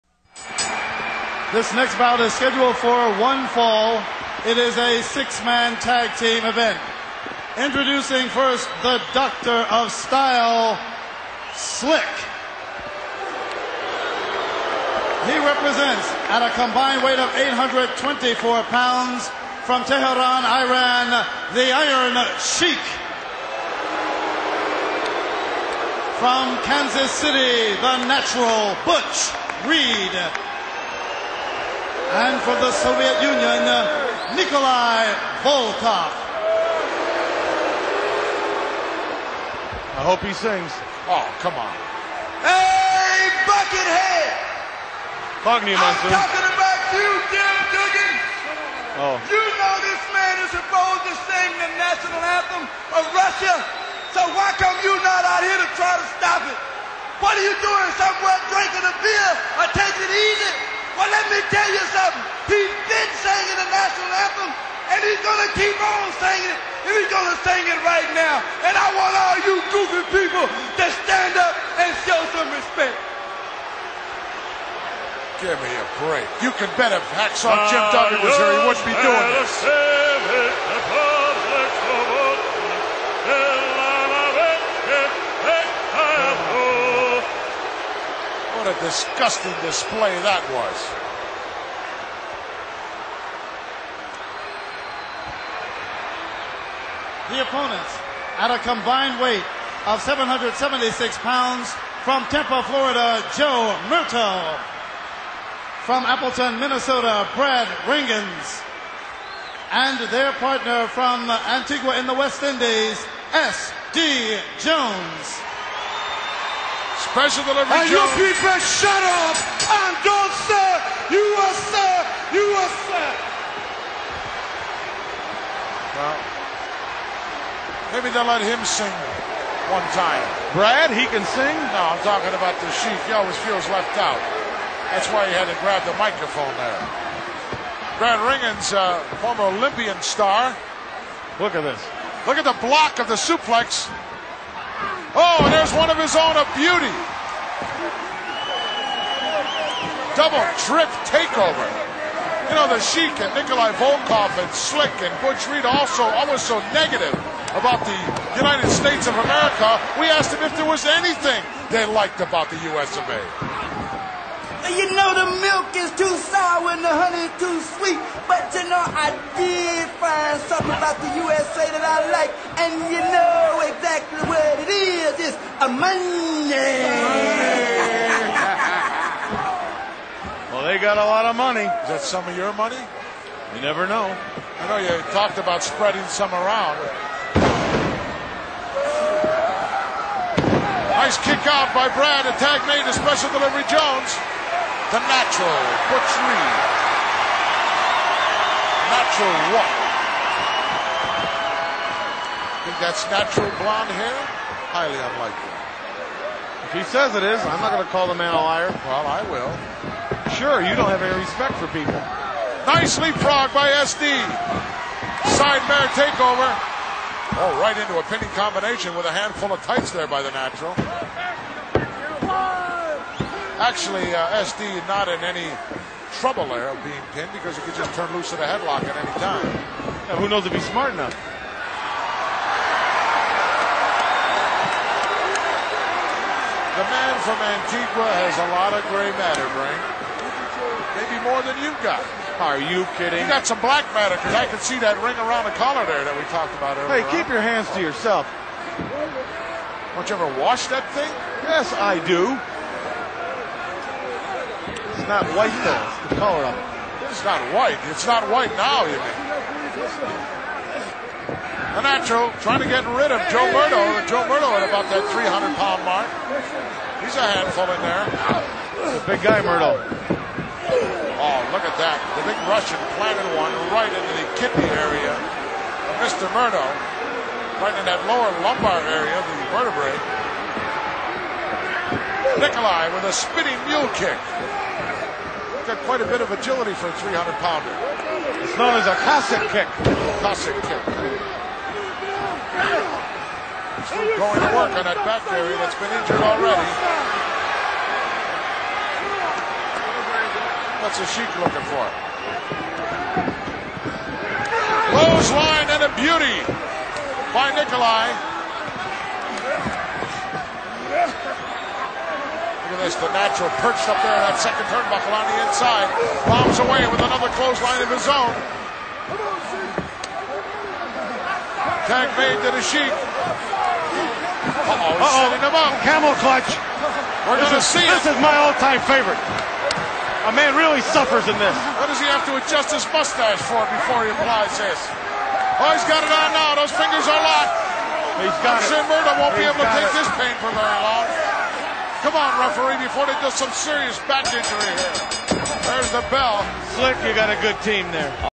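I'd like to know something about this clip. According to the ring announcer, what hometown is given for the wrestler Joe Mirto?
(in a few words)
Tampa, Florida.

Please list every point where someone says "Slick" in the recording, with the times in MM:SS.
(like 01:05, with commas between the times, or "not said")
00:11, 02:34, 05:46.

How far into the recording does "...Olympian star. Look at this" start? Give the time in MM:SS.
02:19.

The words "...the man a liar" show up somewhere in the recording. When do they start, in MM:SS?
03:28.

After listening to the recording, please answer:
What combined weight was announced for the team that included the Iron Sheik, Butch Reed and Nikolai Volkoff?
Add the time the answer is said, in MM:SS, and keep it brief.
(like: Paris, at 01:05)
824 pounds, at 00:17.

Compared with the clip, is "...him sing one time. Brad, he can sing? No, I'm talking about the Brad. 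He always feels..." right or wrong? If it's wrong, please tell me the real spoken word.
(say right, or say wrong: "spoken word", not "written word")
wrong: "Sheik", not "Brad".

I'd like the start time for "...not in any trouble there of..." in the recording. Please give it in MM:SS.
03:44.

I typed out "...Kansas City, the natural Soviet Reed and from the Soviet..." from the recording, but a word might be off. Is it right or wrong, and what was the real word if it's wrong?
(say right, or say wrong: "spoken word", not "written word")
wrong: "Butch", not "Soviet".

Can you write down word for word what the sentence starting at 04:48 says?
It's known as a Cossack kick.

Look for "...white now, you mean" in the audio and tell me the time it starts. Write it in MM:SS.
04:18.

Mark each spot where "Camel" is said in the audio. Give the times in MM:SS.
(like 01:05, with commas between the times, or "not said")
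05:25.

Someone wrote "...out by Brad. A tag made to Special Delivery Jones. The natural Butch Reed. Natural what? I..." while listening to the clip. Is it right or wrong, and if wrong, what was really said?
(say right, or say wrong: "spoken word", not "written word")
right.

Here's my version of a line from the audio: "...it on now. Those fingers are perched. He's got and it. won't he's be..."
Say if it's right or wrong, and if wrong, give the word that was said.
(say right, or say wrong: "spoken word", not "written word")
wrong: "locked", not "perched".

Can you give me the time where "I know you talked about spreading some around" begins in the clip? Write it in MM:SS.
03:04.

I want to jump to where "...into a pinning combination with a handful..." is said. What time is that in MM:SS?
03:37.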